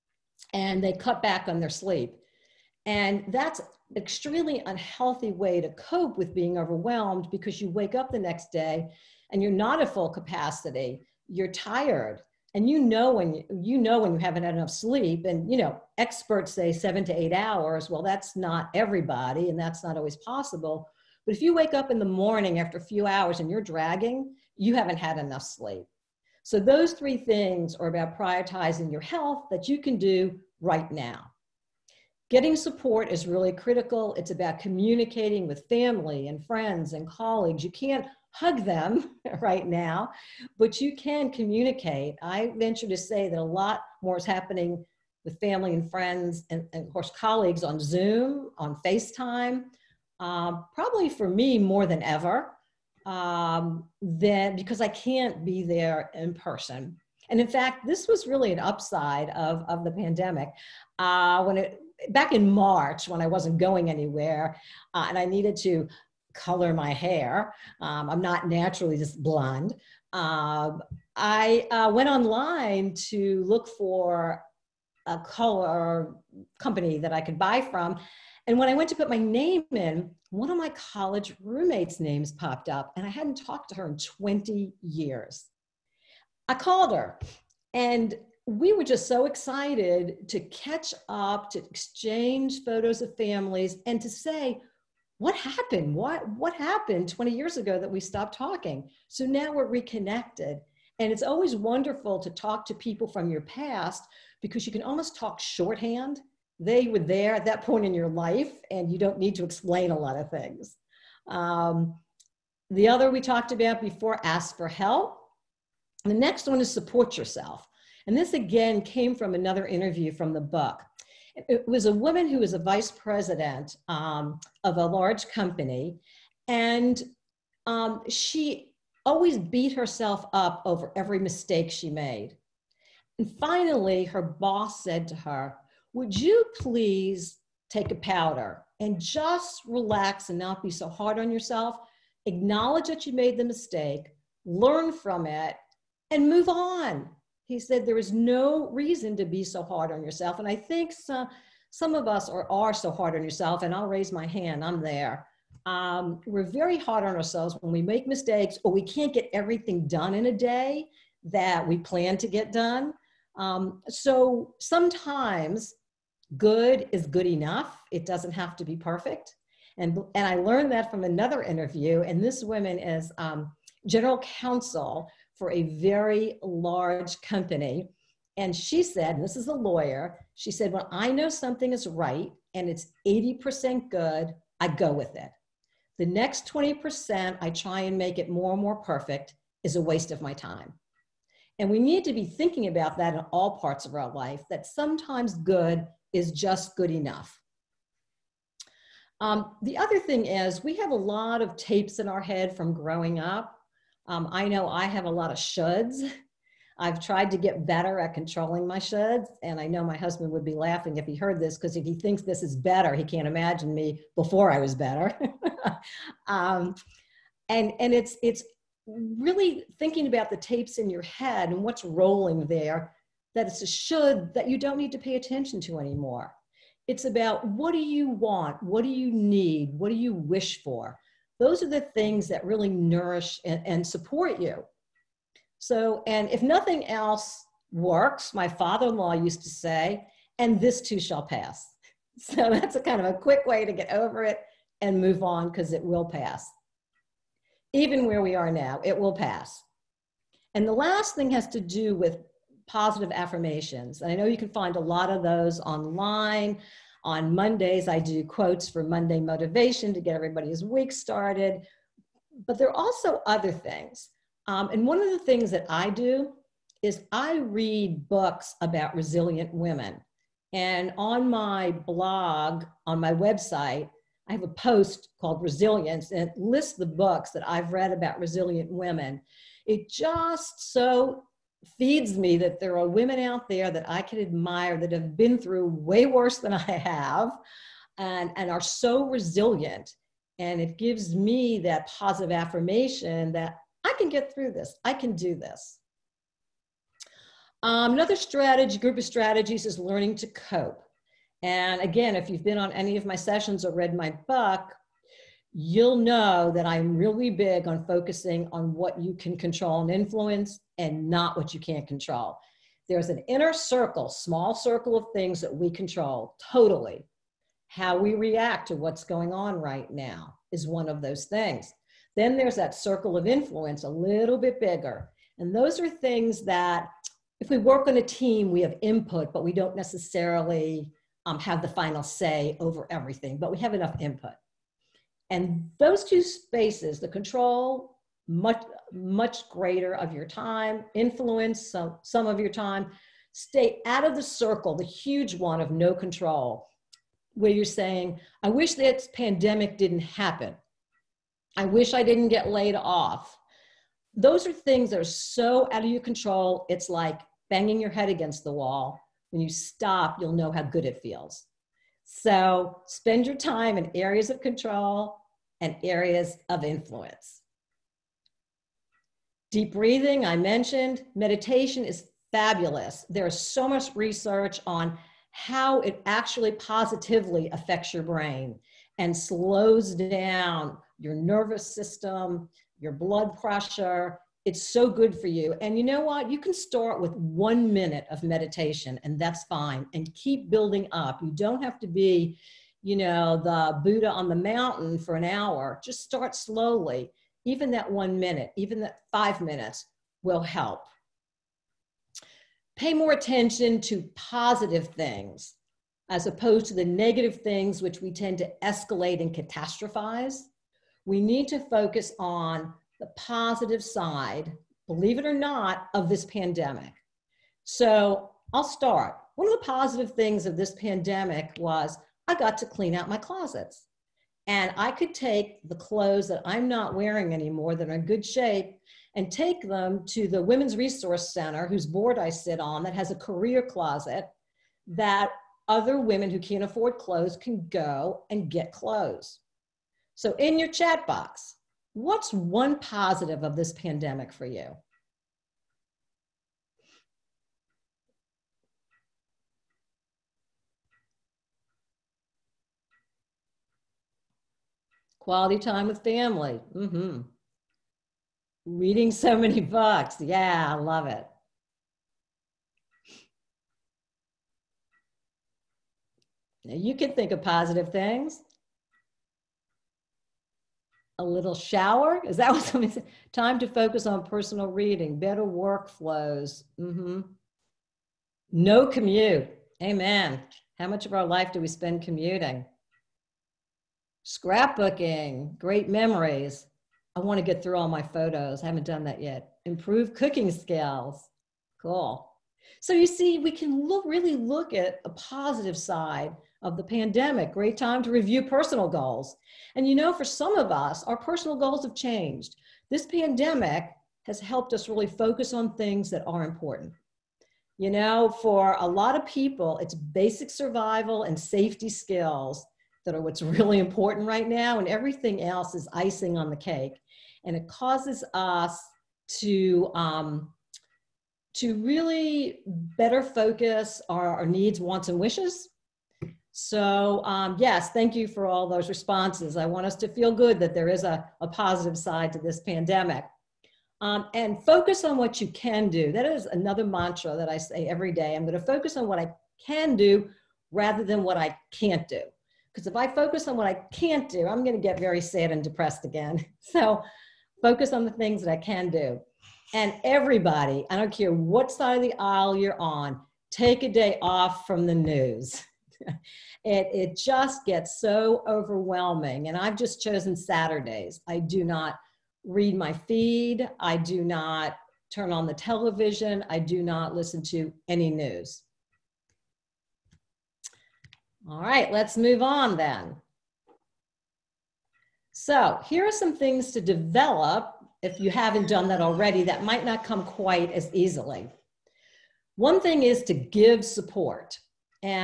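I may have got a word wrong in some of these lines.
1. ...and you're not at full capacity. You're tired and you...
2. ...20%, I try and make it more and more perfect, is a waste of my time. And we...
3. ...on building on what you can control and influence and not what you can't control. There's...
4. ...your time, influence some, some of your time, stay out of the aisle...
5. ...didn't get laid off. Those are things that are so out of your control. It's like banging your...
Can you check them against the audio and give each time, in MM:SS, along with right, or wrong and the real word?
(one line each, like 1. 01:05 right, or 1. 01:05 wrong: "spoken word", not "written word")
1. 00:09 right
2. 03:06 right
3. 05:07 wrong: "focusing", not "building"
4. 05:40 wrong: "circle", not "aisle"
5. 05:52 right.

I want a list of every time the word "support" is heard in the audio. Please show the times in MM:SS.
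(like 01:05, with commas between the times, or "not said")
00:32, 01:56, 03:53, 09:43.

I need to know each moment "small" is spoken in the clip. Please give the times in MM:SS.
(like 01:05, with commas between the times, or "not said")
05:14.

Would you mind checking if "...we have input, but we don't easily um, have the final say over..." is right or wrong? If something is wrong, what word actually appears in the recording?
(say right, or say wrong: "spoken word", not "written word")
wrong: "necessarily", not "easily".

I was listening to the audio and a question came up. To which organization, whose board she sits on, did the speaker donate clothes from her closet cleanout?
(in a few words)
Women's Resource Center.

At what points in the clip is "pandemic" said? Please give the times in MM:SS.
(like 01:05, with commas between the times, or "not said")
00:59, 05:49, 06:56, 07:00, 07:23, 08:16, 08:23, 08:52.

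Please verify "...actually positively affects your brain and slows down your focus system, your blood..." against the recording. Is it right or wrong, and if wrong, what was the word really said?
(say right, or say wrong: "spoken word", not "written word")
wrong: "nervous", not "focus".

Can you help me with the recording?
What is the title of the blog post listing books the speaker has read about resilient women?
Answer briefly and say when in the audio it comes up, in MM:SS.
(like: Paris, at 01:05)
Resilience, at 04:35.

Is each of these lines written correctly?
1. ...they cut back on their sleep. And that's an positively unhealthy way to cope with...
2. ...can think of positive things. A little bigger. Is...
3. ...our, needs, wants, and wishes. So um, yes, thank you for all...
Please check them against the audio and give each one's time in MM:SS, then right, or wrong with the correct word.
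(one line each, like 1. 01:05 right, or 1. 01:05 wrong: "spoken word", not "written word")
1. 00:00 wrong: "extremely", not "positively"
2. 07:46 wrong: "shower", not "bigger"
3. 08:44 right.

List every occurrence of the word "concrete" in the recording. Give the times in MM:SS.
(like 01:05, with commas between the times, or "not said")
not said.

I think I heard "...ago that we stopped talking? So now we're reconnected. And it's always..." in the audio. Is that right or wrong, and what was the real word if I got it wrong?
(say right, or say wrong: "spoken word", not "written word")
right.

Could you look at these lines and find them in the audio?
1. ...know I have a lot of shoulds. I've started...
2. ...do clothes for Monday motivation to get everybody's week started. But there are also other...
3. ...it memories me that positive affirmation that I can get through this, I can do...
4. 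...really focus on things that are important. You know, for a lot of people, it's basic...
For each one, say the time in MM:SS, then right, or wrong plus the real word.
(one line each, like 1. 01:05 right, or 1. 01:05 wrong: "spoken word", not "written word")
1. 03:24 wrong: "tried", not "started"
2. 04:17 wrong: "quotes", not "clothes"
3. 04:50 wrong: "gives", not "memories"
4. 08:24 right.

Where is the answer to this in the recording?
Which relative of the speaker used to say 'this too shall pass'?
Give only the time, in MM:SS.
03:58.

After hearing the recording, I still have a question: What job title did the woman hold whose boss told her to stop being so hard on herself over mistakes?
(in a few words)
vice president.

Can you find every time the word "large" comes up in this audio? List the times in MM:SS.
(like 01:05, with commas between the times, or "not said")
02:04, 02:56.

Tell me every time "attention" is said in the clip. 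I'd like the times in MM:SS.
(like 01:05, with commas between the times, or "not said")
03:45, 06:43.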